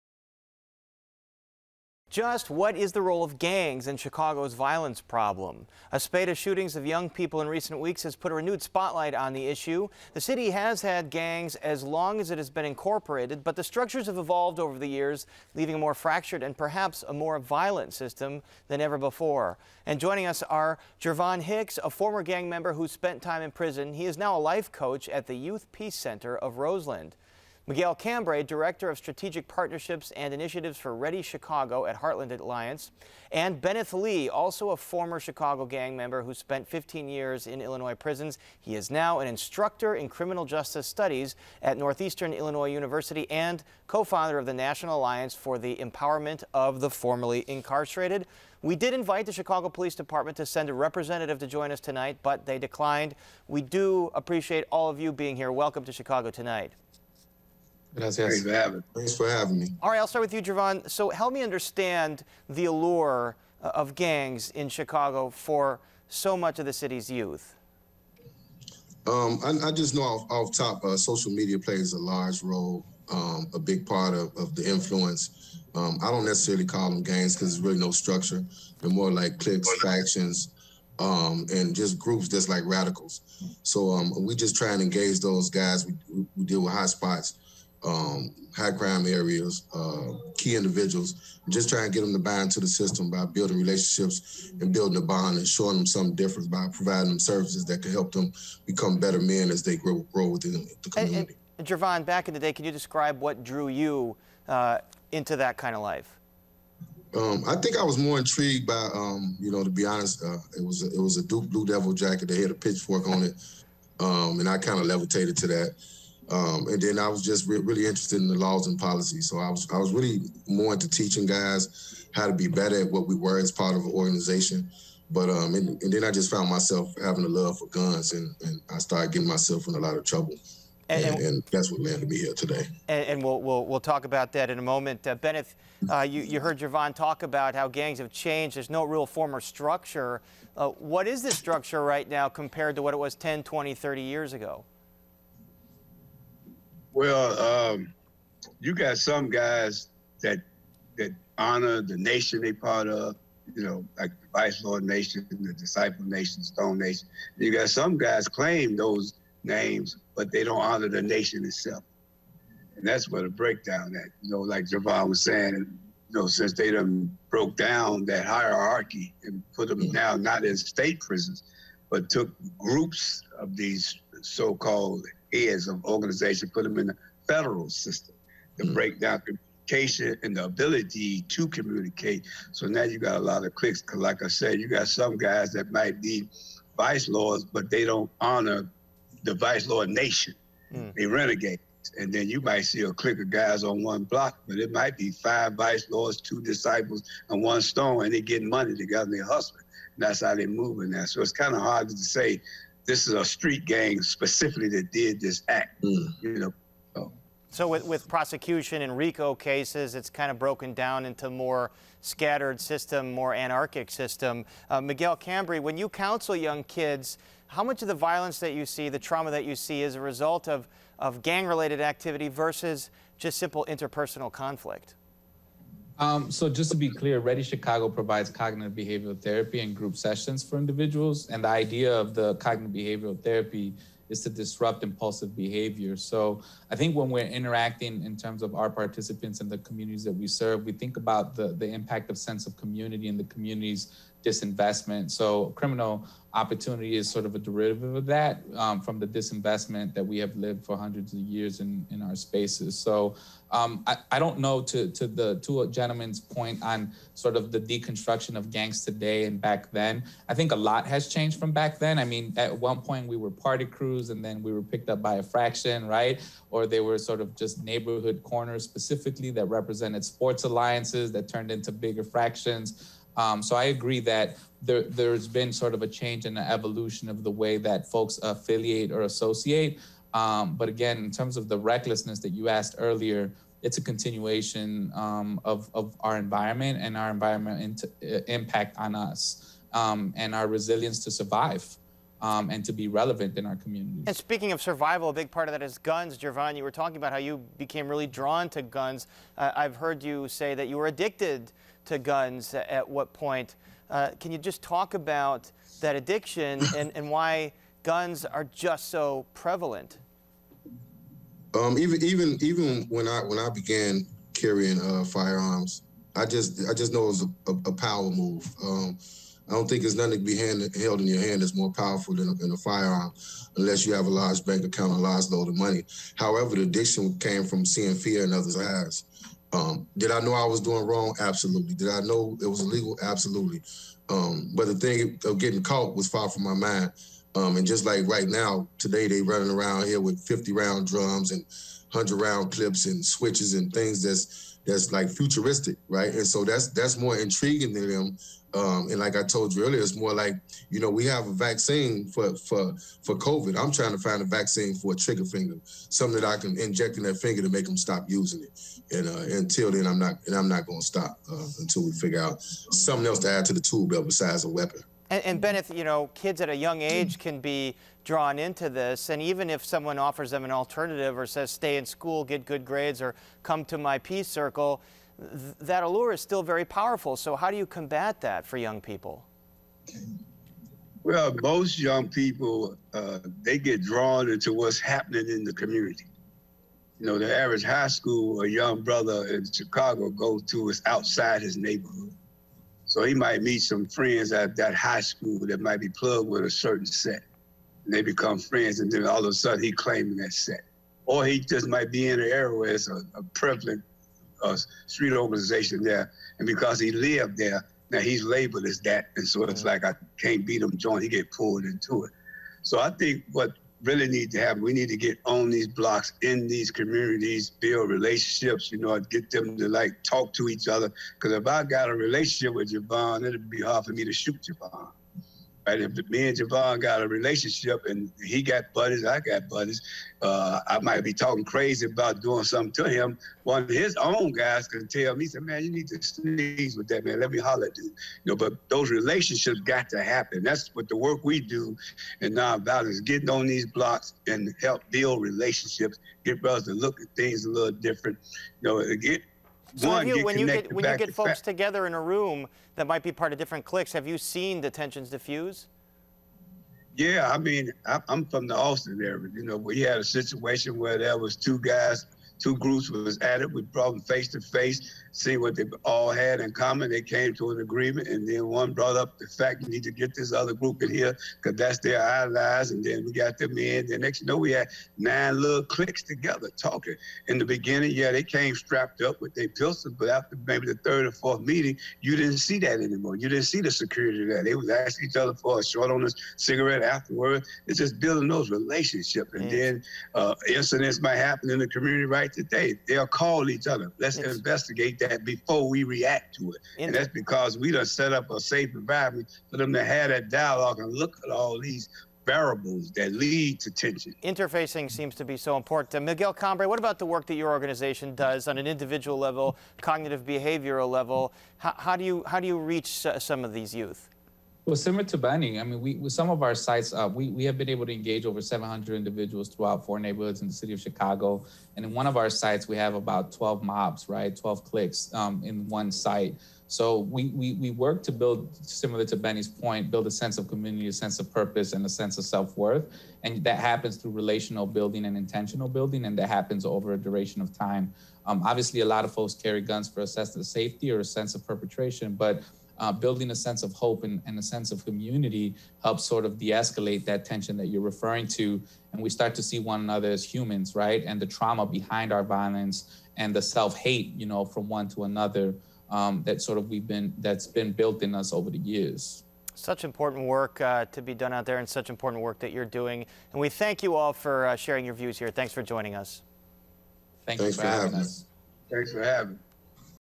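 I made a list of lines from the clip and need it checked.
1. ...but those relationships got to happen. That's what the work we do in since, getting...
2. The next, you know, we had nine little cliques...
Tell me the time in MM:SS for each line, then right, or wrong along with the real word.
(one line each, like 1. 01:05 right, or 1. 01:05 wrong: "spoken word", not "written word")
1. 07:18 wrong: "nonviolence", not "since"
2. 07:53 right.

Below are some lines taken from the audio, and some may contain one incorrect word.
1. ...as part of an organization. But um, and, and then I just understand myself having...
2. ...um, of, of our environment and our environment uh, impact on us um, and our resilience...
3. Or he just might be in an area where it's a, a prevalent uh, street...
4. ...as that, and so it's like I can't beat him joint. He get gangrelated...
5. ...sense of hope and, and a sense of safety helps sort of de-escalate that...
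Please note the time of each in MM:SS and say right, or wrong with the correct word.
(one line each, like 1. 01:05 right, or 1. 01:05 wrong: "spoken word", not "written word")
1. 02:03 wrong: "found", not "understand"
2. 04:44 right
3. 06:41 right
4. 06:48 wrong: "pulled", not "gangrelated"
5. 09:03 wrong: "community", not "safety".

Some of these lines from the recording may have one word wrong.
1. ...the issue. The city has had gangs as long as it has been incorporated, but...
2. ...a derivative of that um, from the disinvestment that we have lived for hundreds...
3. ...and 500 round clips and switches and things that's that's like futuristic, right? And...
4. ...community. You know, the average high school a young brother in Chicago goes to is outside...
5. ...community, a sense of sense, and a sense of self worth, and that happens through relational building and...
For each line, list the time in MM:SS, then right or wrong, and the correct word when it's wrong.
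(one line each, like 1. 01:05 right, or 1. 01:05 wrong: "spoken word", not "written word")
1. 00:09 right
2. 04:07 right
3. 05:41 wrong: "100", not "500"
4. 06:25 right
5. 08:50 wrong: "purpose", not "sense".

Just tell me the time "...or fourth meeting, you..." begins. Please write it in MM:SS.
08:01.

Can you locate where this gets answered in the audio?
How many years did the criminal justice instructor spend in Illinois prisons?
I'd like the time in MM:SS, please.
00:36.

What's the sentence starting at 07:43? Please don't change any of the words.
We brought them face to face, see what they all had in common.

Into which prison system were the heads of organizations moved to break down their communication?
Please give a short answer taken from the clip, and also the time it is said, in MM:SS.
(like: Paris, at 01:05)
federal system, at 02:57.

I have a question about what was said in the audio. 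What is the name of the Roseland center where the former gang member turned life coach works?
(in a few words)
Youth Peace Center.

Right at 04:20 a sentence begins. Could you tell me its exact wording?
I think a lot has changed from back then.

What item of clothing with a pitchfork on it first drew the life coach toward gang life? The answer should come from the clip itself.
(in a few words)
Duke Blue Devil jacket.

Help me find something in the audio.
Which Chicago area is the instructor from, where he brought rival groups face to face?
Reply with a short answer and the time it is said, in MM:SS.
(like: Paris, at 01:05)
Austin, at 07:38.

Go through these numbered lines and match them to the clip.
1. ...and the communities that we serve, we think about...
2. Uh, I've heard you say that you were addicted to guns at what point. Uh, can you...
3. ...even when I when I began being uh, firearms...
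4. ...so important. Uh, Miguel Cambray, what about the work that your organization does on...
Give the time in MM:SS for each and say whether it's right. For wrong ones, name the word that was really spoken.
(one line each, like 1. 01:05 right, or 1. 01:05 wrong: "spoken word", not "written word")
1. 03:59 right
2. 04:59 right
3. 05:12 wrong: "carrying", not "being"
4. 08:25 right.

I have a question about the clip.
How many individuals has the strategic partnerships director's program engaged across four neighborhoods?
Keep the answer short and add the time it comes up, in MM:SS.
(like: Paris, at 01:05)
700, at 08:38.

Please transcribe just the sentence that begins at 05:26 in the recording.
However, the addiction came from seeing fear in others' eyes.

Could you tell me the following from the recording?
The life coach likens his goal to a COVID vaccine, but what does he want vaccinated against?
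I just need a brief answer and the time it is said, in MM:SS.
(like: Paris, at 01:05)
trigger finger, at 05:54.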